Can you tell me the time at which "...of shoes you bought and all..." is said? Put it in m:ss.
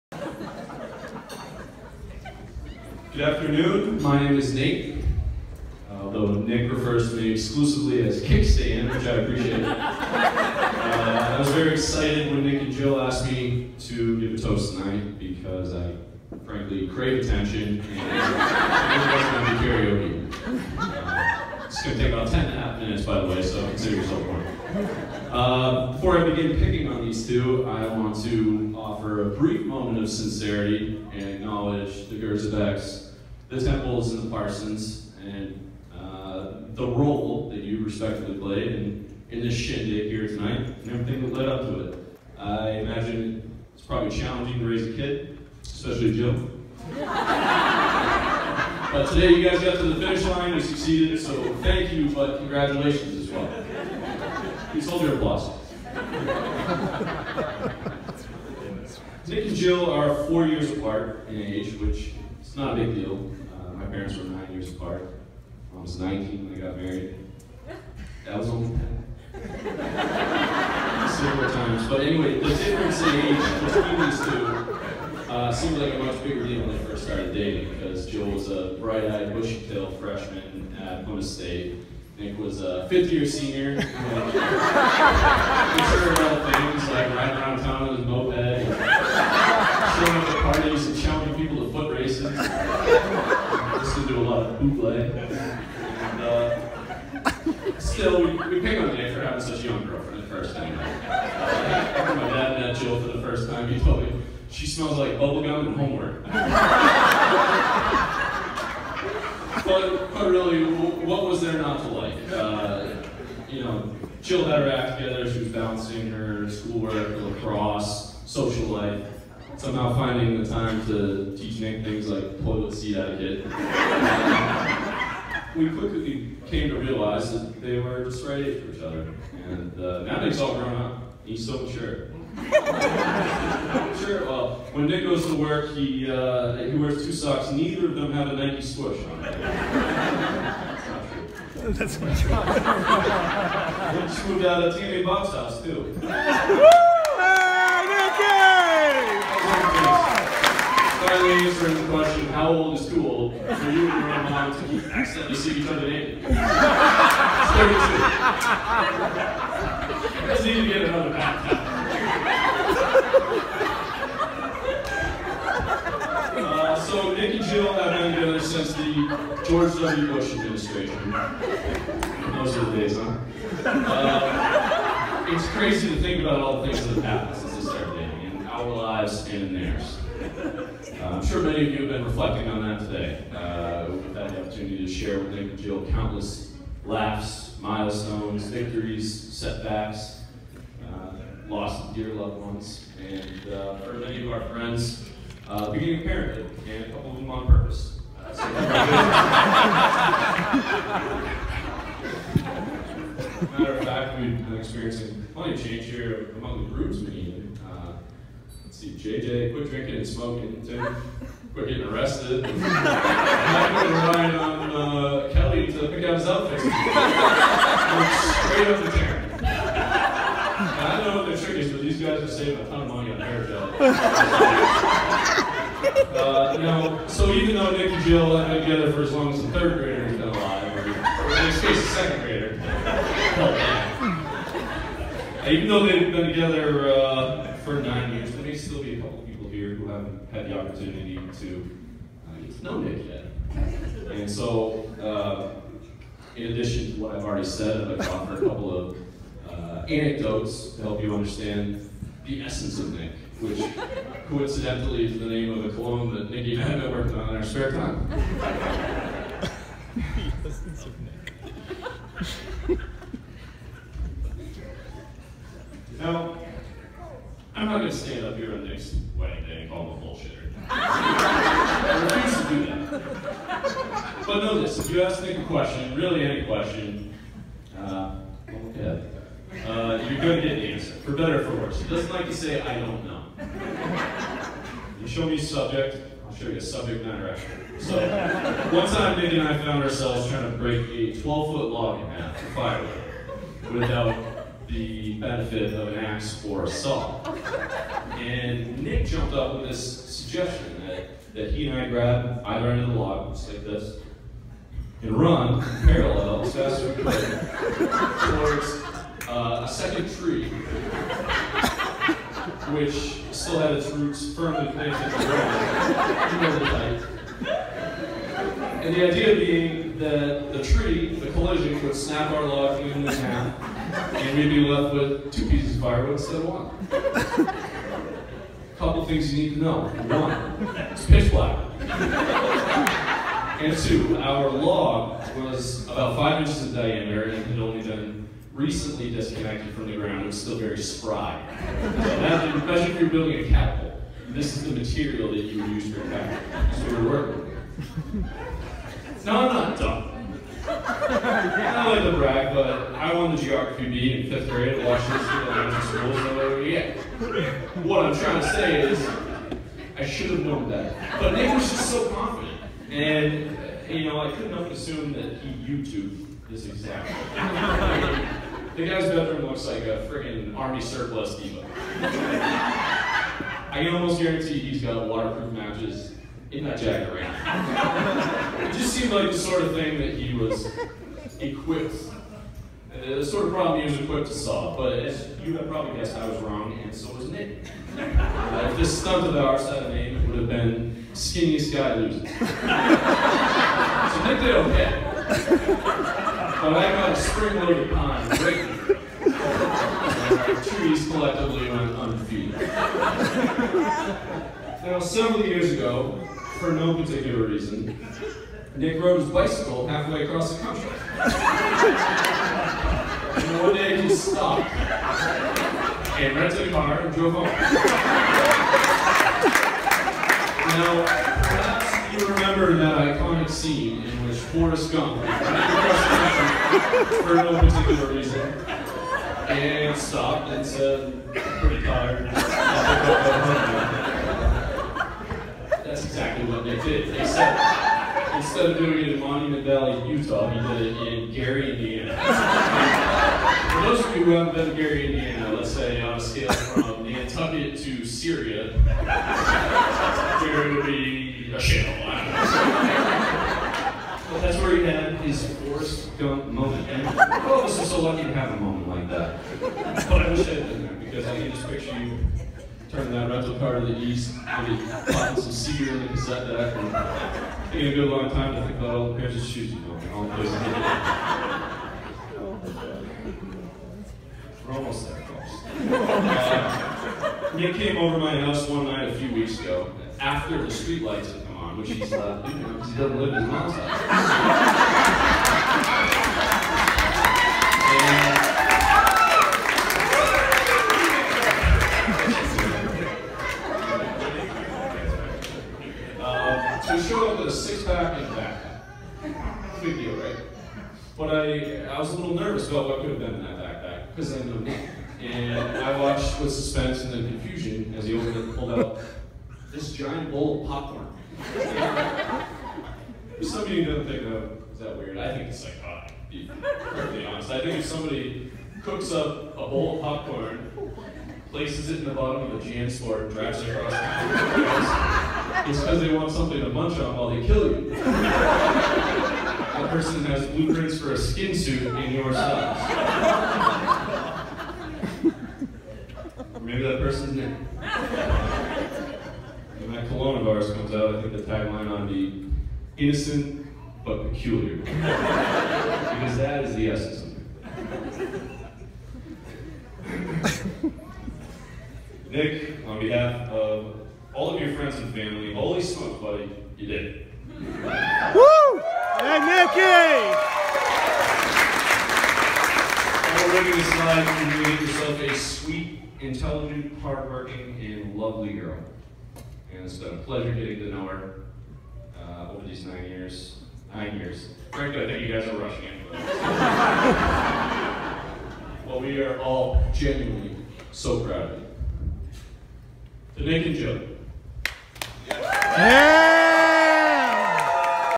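7:49.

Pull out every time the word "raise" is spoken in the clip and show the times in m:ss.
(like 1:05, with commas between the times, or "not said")
0:44.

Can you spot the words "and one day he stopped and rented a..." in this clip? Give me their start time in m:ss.
6:53.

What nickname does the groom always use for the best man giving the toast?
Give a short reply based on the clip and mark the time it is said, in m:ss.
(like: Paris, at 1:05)
Kickstand, at 0:08.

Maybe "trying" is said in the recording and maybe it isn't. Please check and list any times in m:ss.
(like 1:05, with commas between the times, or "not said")
4:50, 5:58.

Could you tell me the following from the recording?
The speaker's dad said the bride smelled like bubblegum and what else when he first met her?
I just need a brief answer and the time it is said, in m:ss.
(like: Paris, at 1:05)
homework, at 1:45.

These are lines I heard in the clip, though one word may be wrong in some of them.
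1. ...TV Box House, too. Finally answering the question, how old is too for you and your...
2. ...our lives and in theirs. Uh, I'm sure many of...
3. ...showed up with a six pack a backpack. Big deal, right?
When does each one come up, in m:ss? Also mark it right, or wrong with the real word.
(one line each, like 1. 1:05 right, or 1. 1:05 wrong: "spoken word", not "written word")
1. 2:24 right
2. 2:58 right
3. 8:17 right.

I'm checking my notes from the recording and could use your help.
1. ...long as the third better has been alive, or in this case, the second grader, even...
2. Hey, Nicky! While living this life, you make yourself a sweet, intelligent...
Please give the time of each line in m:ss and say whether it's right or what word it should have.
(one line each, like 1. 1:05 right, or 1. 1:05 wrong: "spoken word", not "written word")
1. 3:49 wrong: "grader", not "better"
2. 9:19 right.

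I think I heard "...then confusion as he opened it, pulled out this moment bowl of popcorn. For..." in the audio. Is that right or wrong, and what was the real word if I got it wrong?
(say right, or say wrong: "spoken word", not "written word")
wrong: "giant", not "moment".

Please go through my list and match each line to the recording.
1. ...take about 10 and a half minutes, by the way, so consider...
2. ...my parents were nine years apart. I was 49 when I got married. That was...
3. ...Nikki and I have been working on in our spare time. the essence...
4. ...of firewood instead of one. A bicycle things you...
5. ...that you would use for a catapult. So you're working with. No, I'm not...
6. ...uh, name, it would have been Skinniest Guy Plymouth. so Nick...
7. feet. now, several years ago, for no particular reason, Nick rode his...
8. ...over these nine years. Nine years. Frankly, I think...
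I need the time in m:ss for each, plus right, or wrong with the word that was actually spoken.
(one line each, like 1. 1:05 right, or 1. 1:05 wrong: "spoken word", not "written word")
1. 0:22 right
2. 1:03 wrong: "19", not "49"
3. 4:16 right
4. 5:25 wrong: "couple", not "bicycle"
5. 5:45 right
6. 6:29 wrong: "Loses", not "Plymouth"
7. 6:42 right
8. 9:32 right.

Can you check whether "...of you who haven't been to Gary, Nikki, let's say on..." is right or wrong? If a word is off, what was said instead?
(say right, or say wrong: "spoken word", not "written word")
wrong: "Indiana", not "Nikki".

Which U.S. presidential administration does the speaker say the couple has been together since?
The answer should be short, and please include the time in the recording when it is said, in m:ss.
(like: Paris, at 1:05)
George W. Bush, at 2:49.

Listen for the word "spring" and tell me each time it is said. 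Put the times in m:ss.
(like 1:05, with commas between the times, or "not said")
6:37.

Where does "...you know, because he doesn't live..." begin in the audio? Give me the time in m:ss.
8:02.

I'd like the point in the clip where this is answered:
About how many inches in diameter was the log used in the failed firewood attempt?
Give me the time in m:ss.
5:36.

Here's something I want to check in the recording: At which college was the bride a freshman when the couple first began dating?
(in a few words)
Plymouth State.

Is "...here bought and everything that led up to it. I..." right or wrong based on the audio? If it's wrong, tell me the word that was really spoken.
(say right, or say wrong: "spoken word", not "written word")
wrong: "tonight", not "bought".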